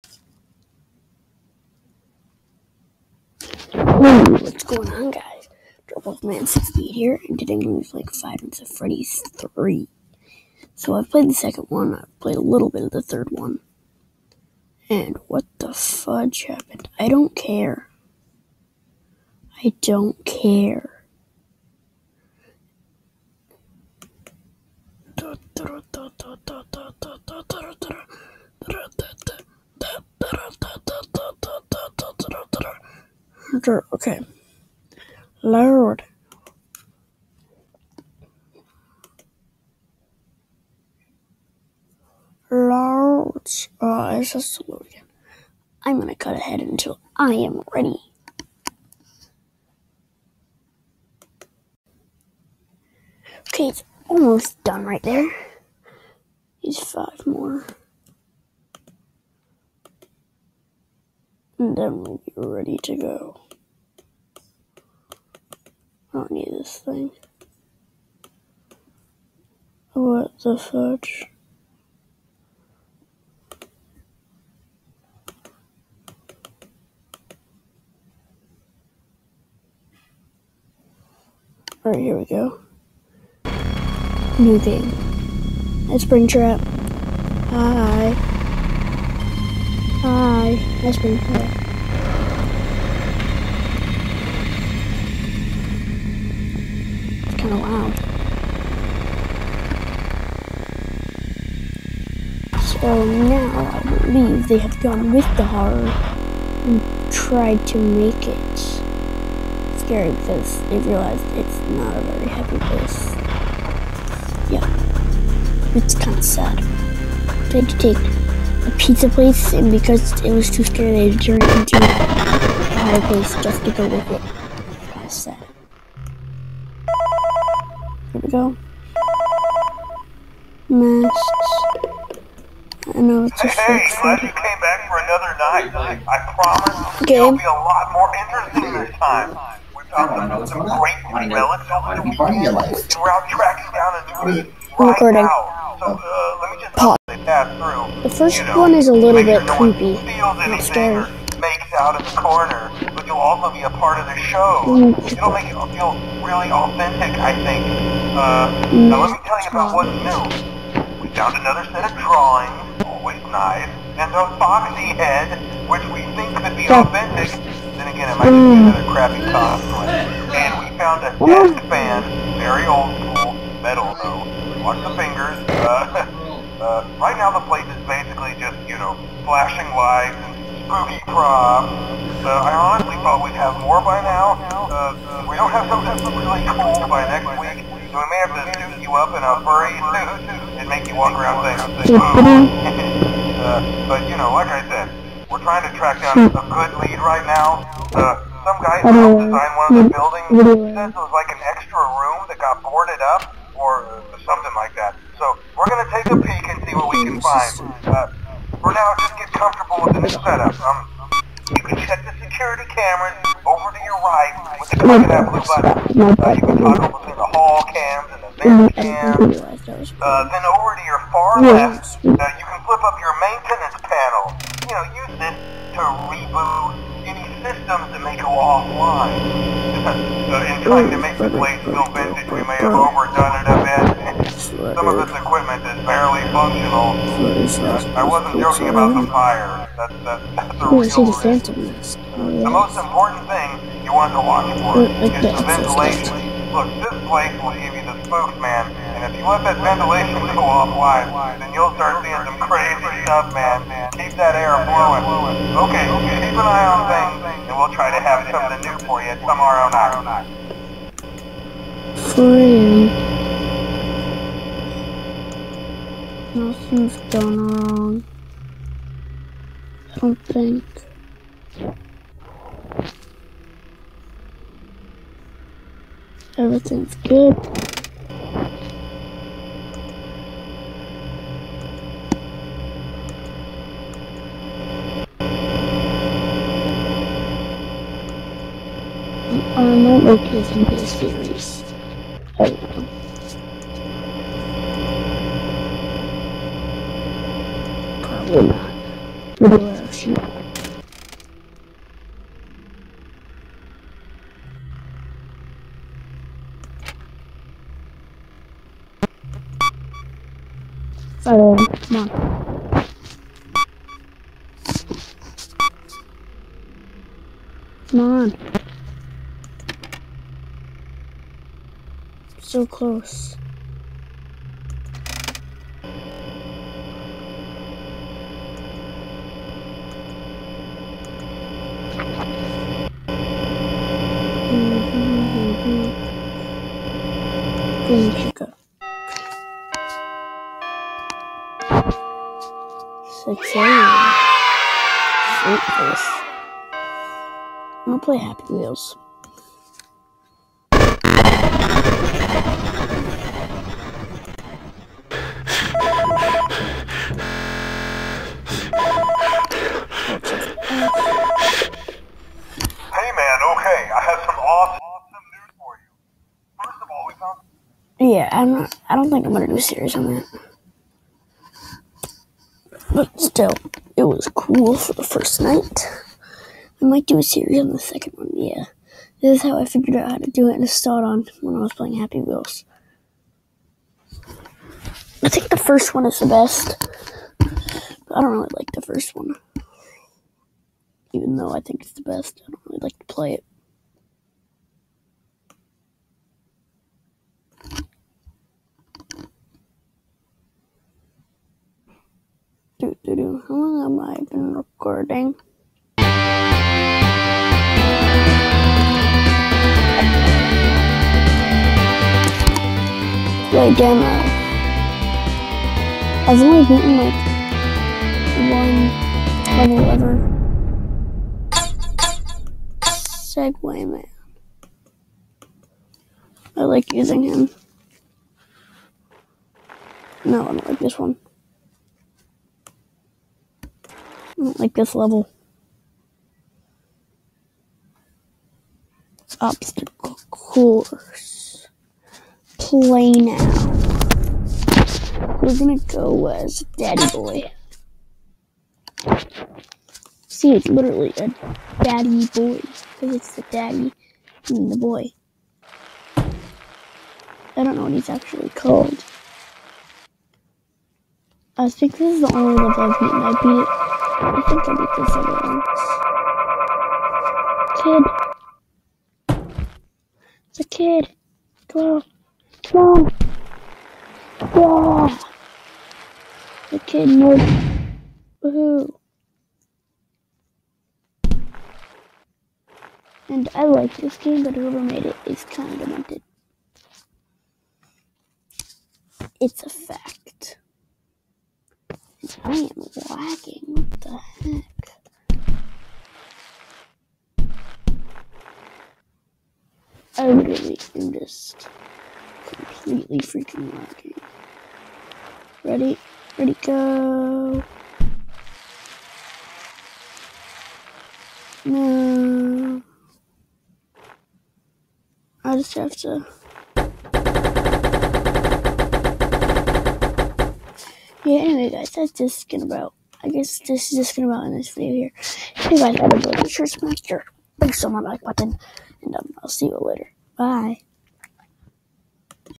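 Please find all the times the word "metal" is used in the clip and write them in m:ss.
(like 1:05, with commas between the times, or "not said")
2:53.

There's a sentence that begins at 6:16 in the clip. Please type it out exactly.
I might do a series on the second one, yeah.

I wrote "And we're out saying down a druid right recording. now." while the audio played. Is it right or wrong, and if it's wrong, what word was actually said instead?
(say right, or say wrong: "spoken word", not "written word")
wrong: "tracking", not "saying".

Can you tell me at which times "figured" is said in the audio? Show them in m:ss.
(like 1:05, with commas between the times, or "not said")
6:19.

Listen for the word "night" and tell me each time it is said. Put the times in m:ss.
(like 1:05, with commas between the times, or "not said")
0:08, 2:15, 4:19, 6:15.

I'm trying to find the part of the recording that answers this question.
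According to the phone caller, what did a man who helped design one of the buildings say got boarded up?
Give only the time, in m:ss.
3:21.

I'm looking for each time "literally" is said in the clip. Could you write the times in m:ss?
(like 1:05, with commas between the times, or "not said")
7:30, 8:20.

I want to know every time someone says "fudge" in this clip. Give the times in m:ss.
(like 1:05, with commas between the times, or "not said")
0:15, 1:10.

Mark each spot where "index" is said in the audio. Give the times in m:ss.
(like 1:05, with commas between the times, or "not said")
not said.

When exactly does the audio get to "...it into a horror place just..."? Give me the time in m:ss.
2:01.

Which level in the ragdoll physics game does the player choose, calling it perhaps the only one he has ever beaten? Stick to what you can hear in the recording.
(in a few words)
Obstacle course.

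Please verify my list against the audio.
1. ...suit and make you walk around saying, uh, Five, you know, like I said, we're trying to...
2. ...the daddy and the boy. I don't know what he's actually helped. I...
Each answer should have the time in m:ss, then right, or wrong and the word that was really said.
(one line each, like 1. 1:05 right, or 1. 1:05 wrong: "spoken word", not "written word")
1. 3:09 wrong: "But", not "Five"
2. 7:33 wrong: "called", not "helped".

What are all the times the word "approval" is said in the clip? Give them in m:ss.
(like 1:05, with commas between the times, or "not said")
not said.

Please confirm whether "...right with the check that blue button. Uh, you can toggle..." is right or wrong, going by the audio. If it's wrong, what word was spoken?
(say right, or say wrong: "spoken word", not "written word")
wrong: "click", not "check".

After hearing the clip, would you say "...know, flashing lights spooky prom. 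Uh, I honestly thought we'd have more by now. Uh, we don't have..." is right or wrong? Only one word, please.
right.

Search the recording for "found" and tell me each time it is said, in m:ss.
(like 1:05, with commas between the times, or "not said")
2:41, 2:50.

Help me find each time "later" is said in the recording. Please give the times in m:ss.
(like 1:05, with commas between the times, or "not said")
8:49.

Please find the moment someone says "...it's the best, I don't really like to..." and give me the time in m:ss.
6:31.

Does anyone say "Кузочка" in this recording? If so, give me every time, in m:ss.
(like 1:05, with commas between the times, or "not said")
5:37.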